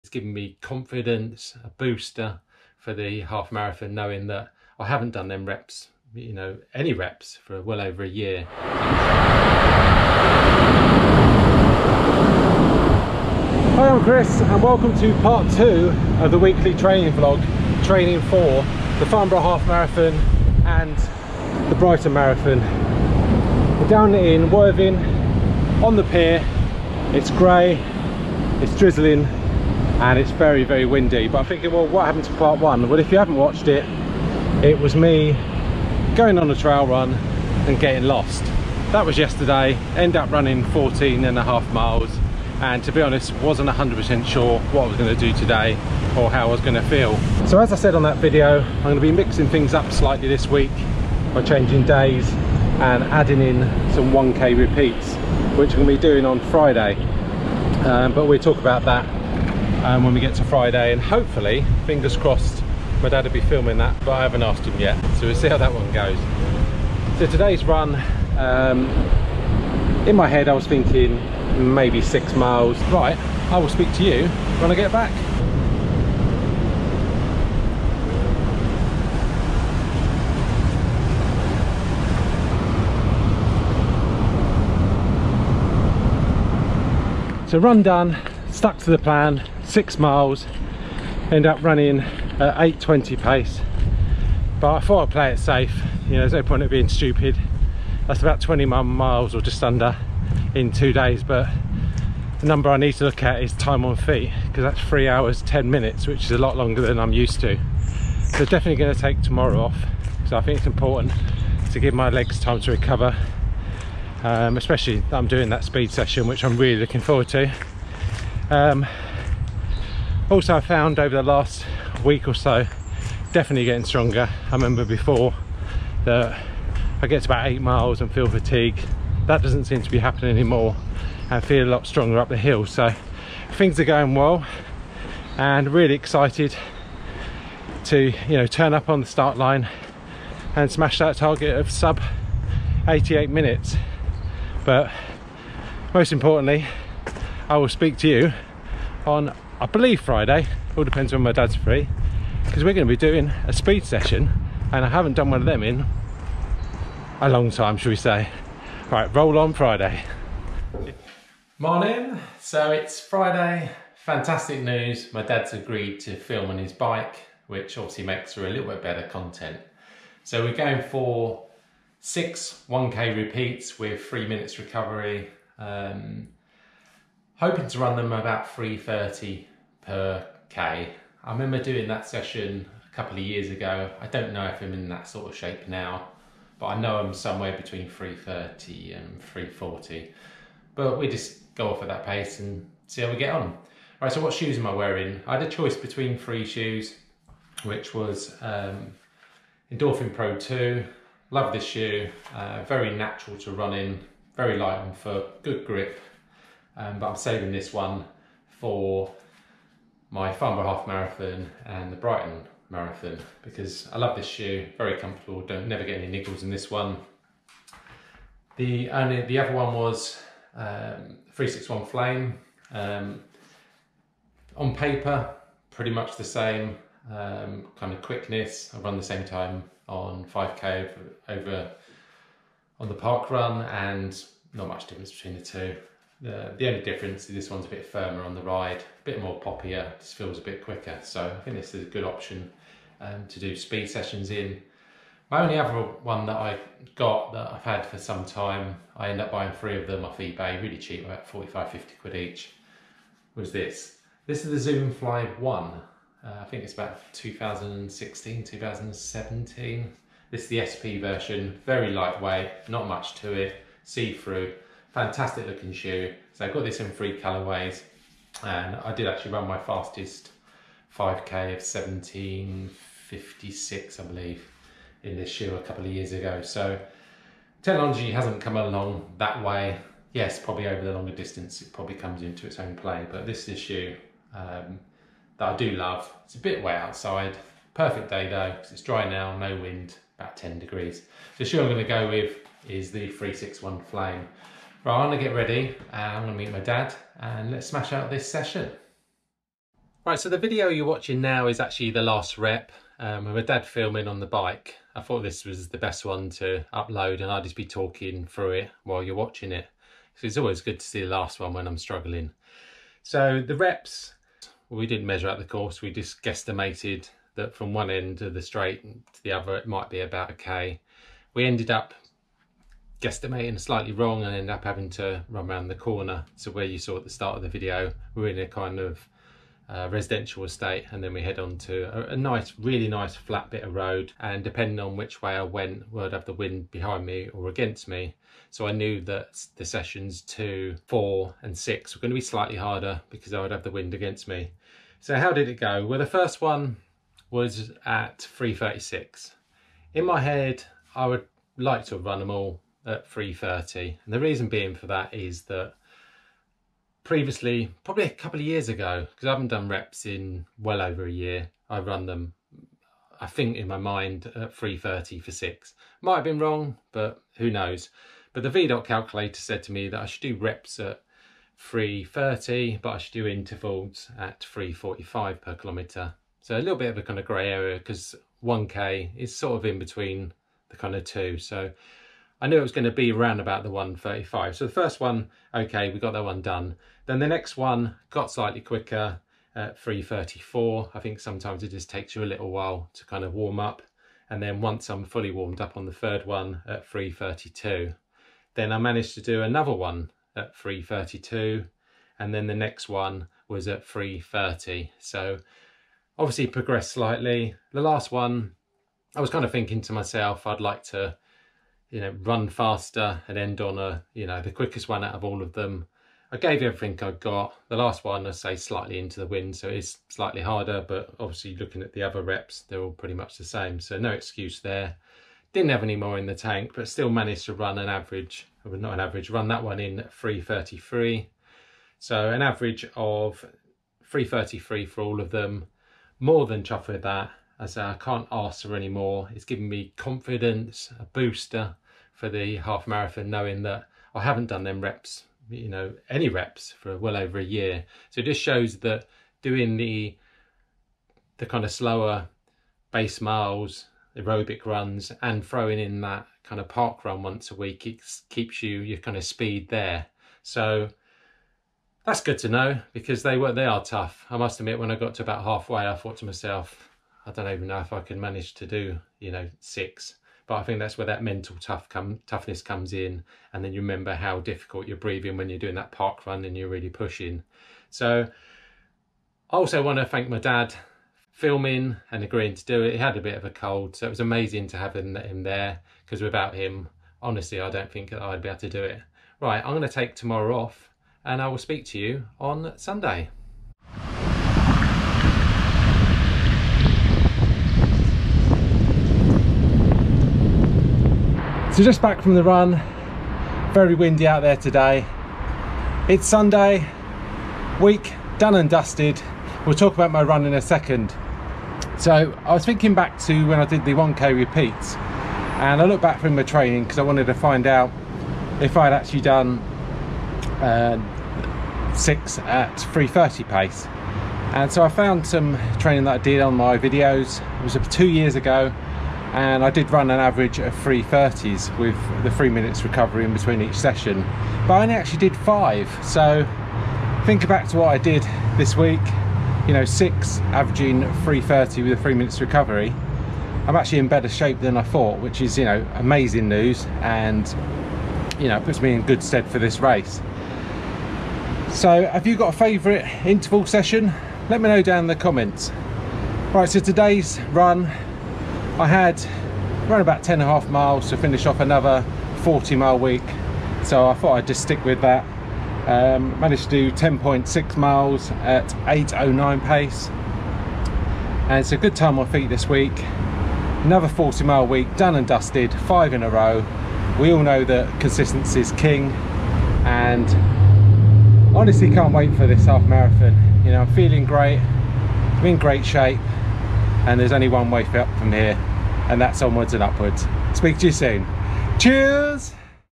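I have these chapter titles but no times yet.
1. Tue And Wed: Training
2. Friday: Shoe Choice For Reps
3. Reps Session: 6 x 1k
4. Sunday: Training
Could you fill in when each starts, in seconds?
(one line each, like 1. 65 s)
1. 13 s
2. 163 s
3. 297 s
4. 493 s.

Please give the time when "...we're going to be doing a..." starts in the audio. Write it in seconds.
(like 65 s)
152 s.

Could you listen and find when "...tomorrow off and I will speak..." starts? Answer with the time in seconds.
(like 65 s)
490 s.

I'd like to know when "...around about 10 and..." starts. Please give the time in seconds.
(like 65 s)
559 s.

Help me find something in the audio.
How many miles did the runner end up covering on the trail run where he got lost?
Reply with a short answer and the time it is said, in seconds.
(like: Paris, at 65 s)
14 and a half miles, at 40 s.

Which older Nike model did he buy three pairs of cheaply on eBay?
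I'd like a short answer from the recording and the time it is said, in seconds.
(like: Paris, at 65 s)
Zoom Fly 1, at 254 s.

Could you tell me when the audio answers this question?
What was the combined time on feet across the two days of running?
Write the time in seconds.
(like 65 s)
104 s.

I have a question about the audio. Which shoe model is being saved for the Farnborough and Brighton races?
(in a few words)
Endorphin Pro 2.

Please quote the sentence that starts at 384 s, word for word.
So the first one, okay, we got that one done.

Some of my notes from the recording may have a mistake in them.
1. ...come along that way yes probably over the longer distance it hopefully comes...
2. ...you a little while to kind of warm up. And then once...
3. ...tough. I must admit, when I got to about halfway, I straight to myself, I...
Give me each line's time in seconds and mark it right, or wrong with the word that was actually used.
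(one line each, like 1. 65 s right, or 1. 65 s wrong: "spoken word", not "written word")
1. 278 s wrong: "probably", not "hopefully"
2. 392 s right
3. 463 s wrong: "thought", not "straight".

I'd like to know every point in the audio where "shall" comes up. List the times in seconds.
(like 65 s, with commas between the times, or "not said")
157 s.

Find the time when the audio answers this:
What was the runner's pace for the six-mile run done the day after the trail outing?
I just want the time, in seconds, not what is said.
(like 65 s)
92 s.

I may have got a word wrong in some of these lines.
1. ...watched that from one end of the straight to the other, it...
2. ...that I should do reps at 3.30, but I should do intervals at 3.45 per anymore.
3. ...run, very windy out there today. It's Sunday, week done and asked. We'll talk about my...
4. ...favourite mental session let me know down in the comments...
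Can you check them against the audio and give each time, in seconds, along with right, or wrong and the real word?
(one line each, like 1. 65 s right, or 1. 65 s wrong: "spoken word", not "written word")
1. 316 s wrong: "guesstimated", not "watched"
2. 369 s wrong: "kilometre", not "anymore"
3. 502 s wrong: "dusted", not "asked"
4. 552 s wrong: "interval", not "mental".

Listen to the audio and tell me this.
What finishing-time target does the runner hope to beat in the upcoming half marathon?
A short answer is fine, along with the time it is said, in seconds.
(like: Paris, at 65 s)
sub 88 minutes, at 141 s.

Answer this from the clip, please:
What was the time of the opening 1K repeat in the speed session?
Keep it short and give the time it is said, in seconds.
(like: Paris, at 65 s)
3:36, at 348 s.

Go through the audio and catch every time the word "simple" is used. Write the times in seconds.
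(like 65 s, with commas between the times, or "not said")
not said.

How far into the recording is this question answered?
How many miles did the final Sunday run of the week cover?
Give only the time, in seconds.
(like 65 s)
566 s.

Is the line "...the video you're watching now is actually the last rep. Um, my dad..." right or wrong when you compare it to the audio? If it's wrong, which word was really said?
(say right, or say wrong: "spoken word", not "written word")
right.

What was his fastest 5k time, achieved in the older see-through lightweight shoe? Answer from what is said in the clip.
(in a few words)
17:56.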